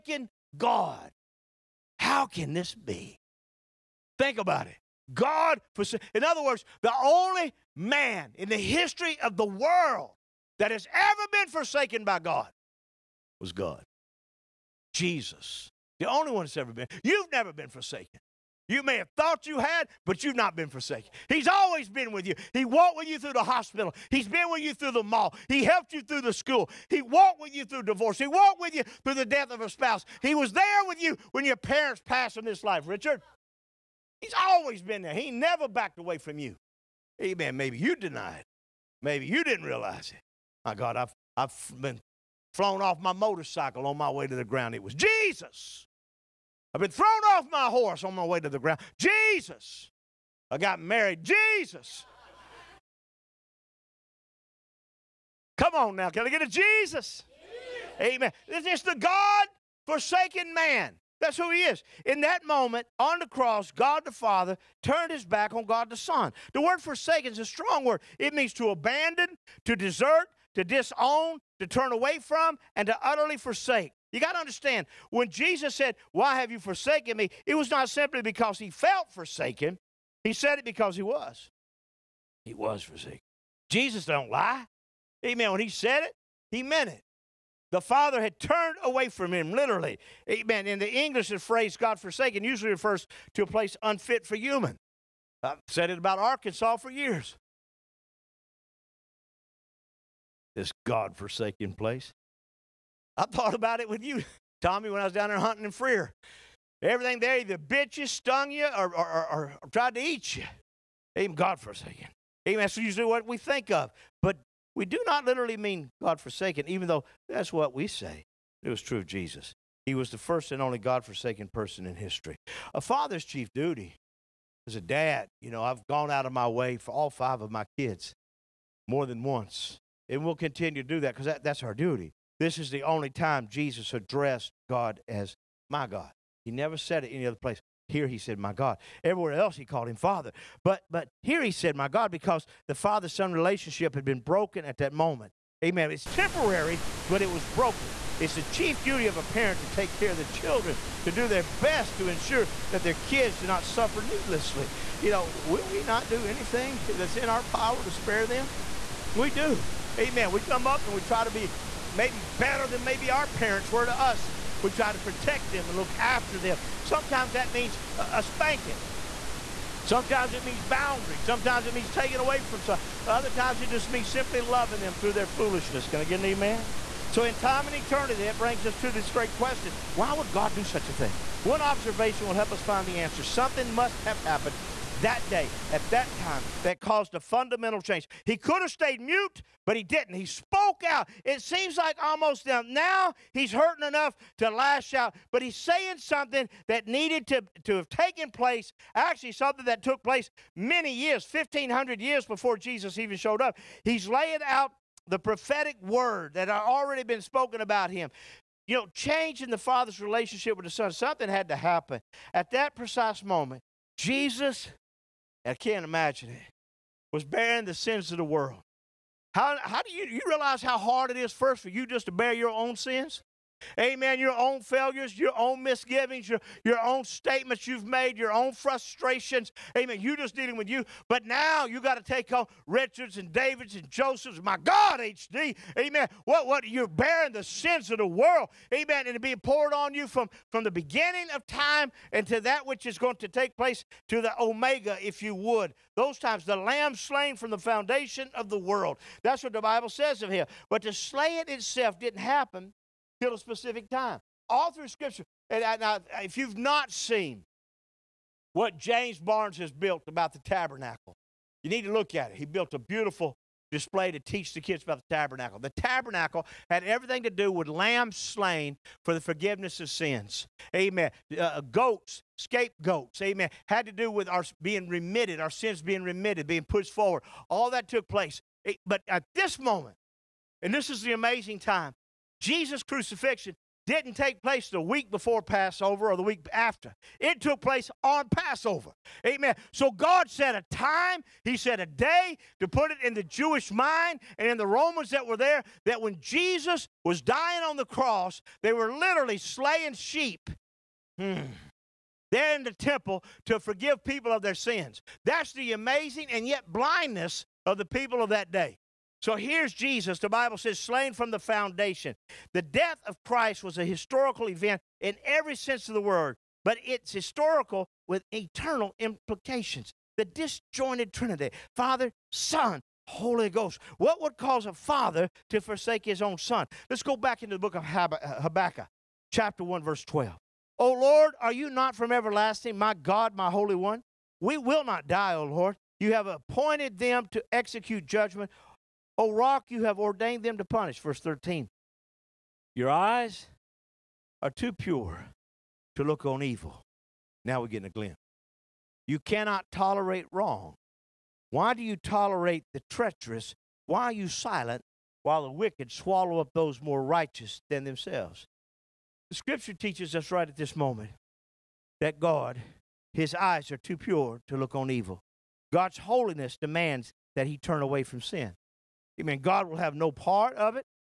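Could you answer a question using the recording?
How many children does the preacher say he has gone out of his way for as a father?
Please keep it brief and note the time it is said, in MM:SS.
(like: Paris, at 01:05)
5, at 02:07.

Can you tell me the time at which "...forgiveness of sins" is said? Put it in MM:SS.
04:29.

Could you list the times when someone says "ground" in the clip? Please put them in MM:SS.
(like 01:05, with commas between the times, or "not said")
00:44, 00:48.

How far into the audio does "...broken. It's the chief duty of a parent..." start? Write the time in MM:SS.
02:27.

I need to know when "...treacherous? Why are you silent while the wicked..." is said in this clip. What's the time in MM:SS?
05:52.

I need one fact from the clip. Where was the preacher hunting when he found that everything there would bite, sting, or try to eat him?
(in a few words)
Freer.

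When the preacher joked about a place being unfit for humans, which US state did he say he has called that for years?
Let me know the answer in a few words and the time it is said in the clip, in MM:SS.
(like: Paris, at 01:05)
Arkansas, at 01:36.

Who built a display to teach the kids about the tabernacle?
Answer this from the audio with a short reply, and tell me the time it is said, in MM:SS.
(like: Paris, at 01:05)
James Barnes, at 04:18.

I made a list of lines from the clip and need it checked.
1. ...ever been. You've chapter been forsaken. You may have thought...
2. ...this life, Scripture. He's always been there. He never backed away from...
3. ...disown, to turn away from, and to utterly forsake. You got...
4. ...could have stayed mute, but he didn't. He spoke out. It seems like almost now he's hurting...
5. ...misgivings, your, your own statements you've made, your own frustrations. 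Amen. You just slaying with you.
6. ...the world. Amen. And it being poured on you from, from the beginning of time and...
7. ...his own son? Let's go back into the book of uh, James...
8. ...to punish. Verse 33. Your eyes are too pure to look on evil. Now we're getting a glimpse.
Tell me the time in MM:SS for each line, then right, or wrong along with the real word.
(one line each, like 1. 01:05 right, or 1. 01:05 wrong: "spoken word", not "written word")
1. 00:16 wrong: "never", not "chapter"
2. 00:32 wrong: "Richard", not "Scripture"
3. 01:10 right
4. 03:08 right
5. 03:45 wrong: "dealing", not "slaying"
6. 03:57 right
7. 05:26 wrong: "Habakkuk", not "James"
8. 05:40 wrong: "13", not "33".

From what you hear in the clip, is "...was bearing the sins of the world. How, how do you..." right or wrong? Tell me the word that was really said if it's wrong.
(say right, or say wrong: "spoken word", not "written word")
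right.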